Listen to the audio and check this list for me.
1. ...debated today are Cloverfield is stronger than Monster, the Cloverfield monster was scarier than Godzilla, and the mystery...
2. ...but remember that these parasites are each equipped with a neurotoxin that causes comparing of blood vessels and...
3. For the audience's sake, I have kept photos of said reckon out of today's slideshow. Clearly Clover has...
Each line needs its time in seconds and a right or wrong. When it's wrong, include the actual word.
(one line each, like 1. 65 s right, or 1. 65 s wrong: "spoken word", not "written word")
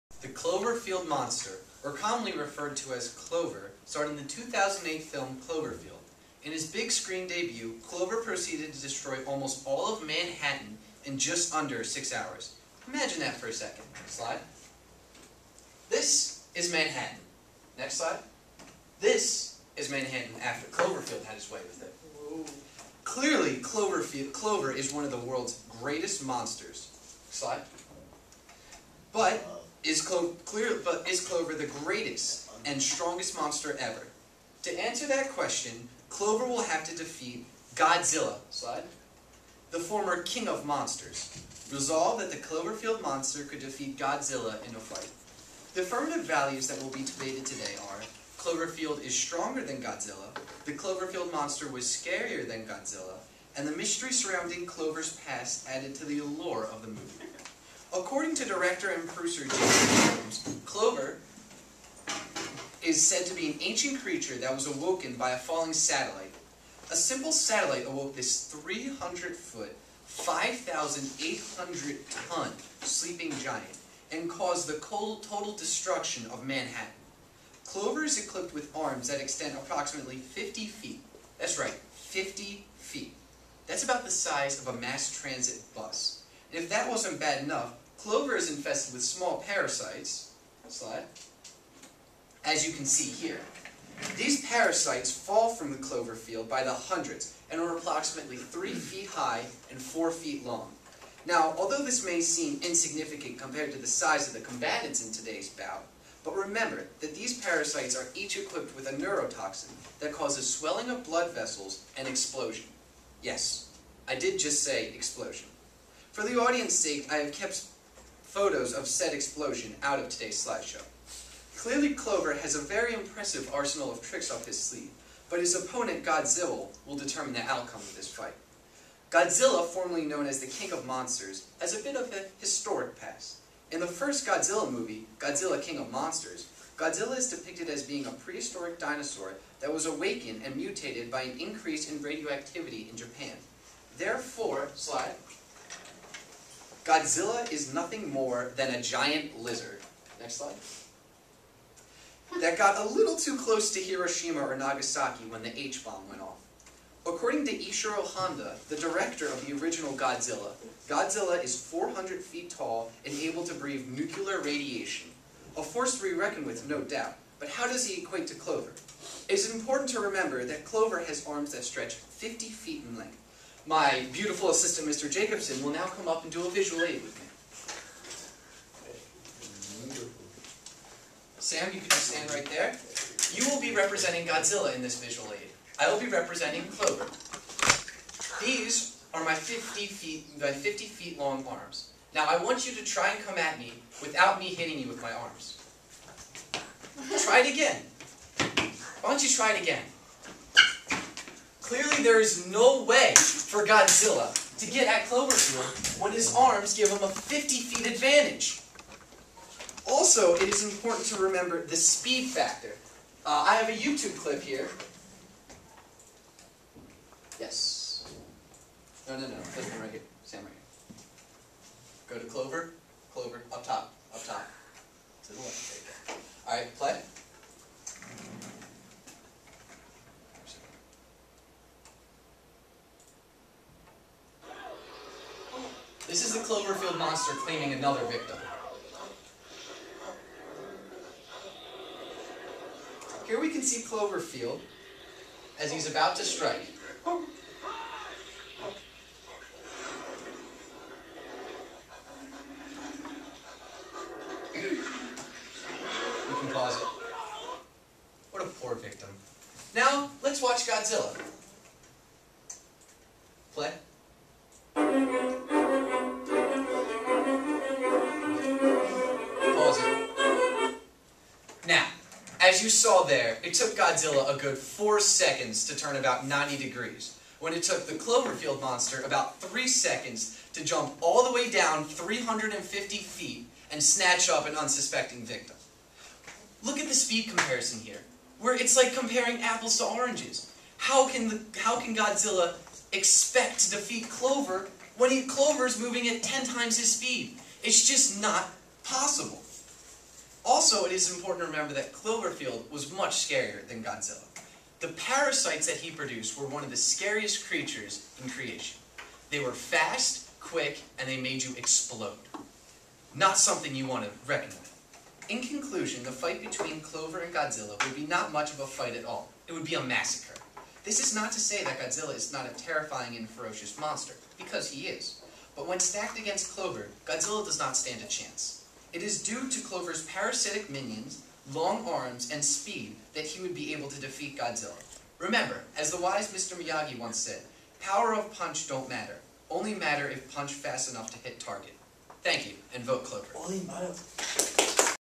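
1. 47 s wrong: "Godzilla", not "Monster"
2. 106 s wrong: "swelling", not "comparing"
3. 116 s wrong: "explosion", not "reckon".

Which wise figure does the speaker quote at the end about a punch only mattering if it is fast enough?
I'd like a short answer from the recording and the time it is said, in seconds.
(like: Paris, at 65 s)
Mr. Miyagi, at 336 s.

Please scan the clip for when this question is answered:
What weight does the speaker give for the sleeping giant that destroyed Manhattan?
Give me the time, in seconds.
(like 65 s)
70 s.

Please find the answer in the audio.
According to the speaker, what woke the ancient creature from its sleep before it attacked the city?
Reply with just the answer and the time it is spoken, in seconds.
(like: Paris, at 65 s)
A falling satellite, at 65 s.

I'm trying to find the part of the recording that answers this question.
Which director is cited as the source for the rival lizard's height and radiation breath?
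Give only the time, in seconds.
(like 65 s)
157 s.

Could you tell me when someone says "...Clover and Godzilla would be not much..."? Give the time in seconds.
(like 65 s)
316 s.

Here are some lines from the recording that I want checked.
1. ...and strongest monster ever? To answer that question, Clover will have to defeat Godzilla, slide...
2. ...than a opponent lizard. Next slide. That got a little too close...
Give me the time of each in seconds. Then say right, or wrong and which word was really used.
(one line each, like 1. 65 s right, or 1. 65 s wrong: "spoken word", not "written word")
1. 32 s right
2. 148 s wrong: "giant", not "opponent".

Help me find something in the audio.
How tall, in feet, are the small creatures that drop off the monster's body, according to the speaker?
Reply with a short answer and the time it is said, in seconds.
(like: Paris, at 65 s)
3 feet, at 98 s.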